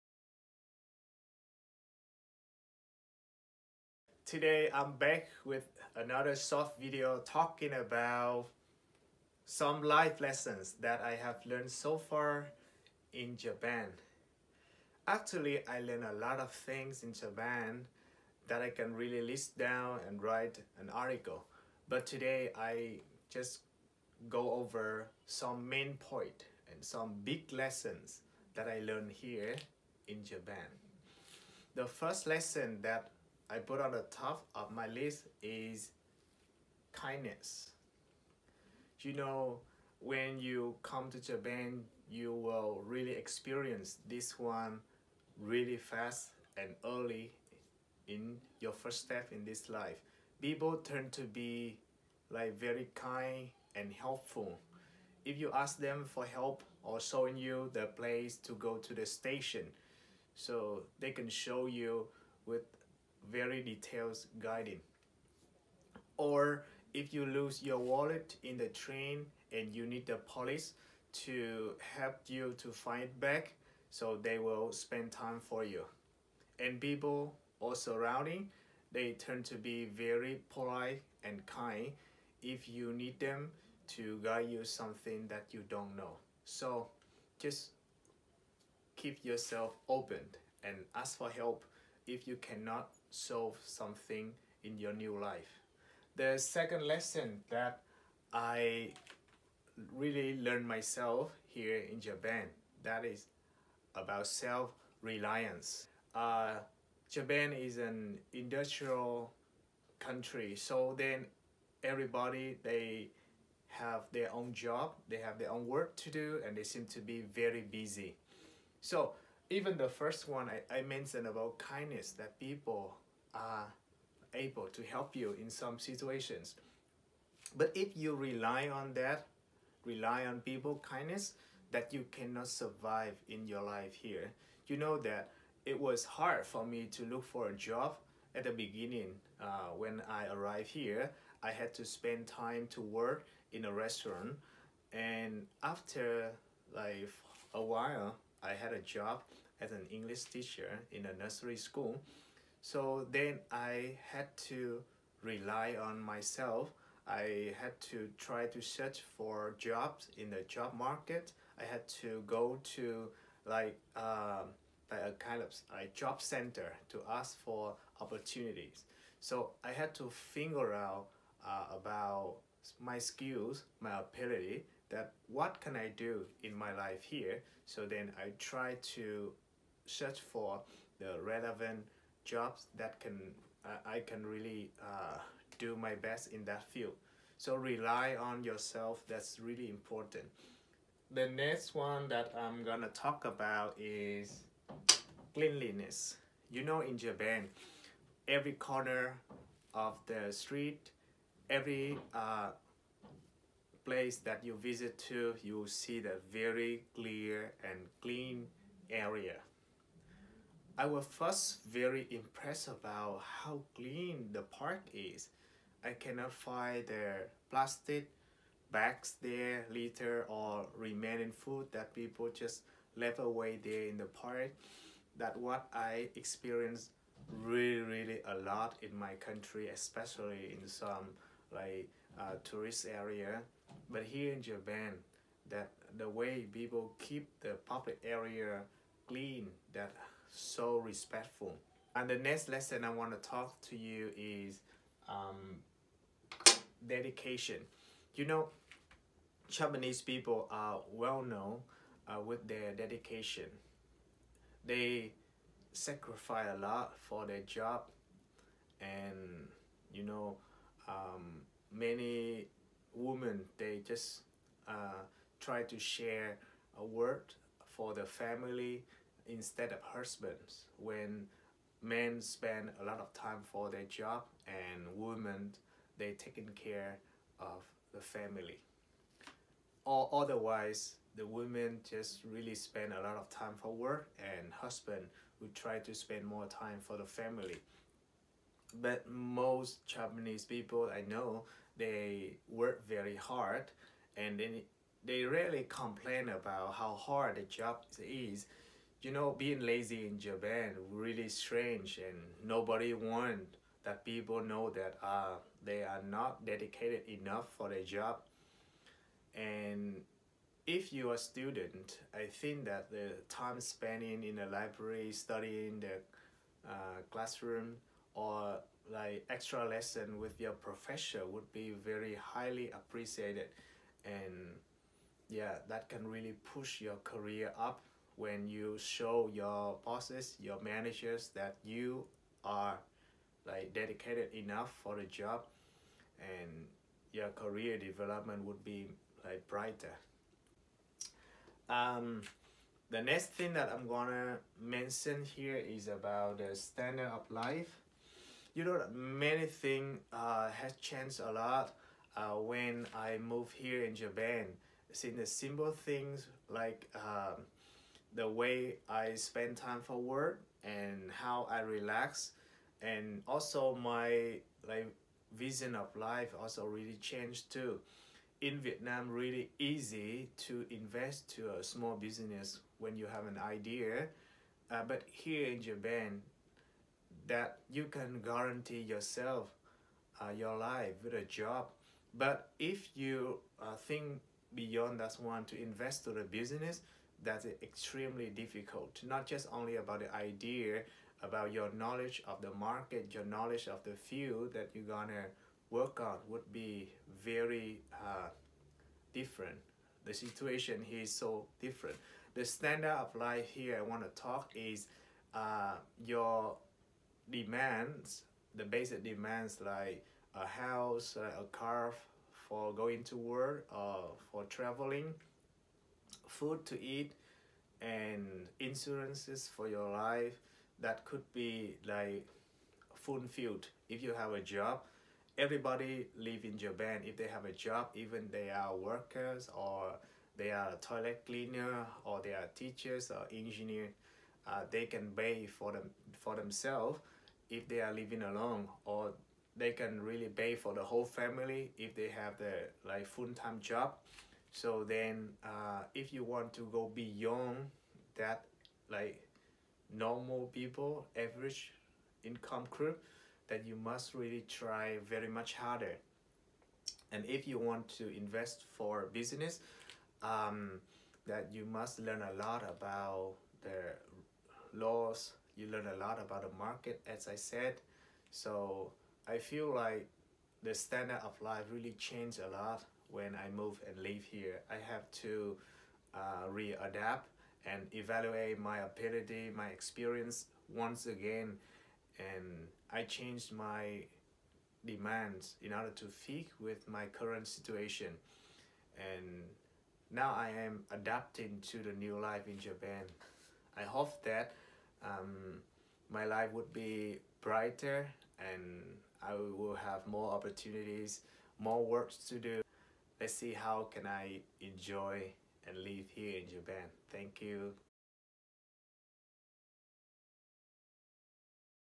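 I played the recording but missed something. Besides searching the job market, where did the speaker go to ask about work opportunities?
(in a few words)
A job center.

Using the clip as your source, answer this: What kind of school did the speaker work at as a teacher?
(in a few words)
Nursery school.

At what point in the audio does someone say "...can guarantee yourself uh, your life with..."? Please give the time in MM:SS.
06:17.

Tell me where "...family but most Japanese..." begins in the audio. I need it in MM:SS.
04:47.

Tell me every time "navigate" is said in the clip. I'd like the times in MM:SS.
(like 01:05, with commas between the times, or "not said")
not said.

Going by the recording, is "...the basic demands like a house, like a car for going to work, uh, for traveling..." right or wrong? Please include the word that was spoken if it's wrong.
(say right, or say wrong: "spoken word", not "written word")
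right.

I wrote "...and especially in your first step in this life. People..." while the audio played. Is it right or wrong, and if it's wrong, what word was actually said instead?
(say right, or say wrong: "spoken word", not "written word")
wrong: "early", not "especially".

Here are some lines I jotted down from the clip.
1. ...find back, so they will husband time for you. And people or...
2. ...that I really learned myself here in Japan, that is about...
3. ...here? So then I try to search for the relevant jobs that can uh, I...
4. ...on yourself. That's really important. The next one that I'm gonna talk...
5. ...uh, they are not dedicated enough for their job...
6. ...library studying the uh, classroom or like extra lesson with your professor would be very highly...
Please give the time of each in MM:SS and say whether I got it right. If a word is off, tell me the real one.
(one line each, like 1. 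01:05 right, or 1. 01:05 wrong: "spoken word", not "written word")
1. 01:12 wrong: "spend", not "husband"
2. 01:37 right
3. 02:57 right
4. 03:08 right
5. 05:05 right
6. 05:14 right.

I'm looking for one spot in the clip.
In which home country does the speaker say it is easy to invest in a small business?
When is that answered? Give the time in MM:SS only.
06:08.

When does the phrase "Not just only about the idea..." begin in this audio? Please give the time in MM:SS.
06:29.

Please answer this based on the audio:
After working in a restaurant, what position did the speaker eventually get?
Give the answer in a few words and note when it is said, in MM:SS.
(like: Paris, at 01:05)
English teacher, at 02:29.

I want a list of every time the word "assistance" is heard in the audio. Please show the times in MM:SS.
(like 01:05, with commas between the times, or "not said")
not said.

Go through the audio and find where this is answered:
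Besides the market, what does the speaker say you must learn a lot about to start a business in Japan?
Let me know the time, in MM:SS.
07:44.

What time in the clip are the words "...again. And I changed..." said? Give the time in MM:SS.
08:01.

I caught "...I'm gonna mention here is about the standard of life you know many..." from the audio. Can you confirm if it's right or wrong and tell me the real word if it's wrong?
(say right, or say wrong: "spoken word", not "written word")
right.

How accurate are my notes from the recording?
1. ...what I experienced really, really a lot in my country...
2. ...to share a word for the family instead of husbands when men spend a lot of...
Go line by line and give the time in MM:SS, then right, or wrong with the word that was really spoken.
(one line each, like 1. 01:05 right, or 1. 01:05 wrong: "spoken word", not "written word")
1. 03:45 right
2. 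04:25 right.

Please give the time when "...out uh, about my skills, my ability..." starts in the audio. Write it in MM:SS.
02:50.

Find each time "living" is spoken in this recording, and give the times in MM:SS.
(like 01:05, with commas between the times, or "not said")
07:17.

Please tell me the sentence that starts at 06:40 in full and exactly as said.
The situation here is so different.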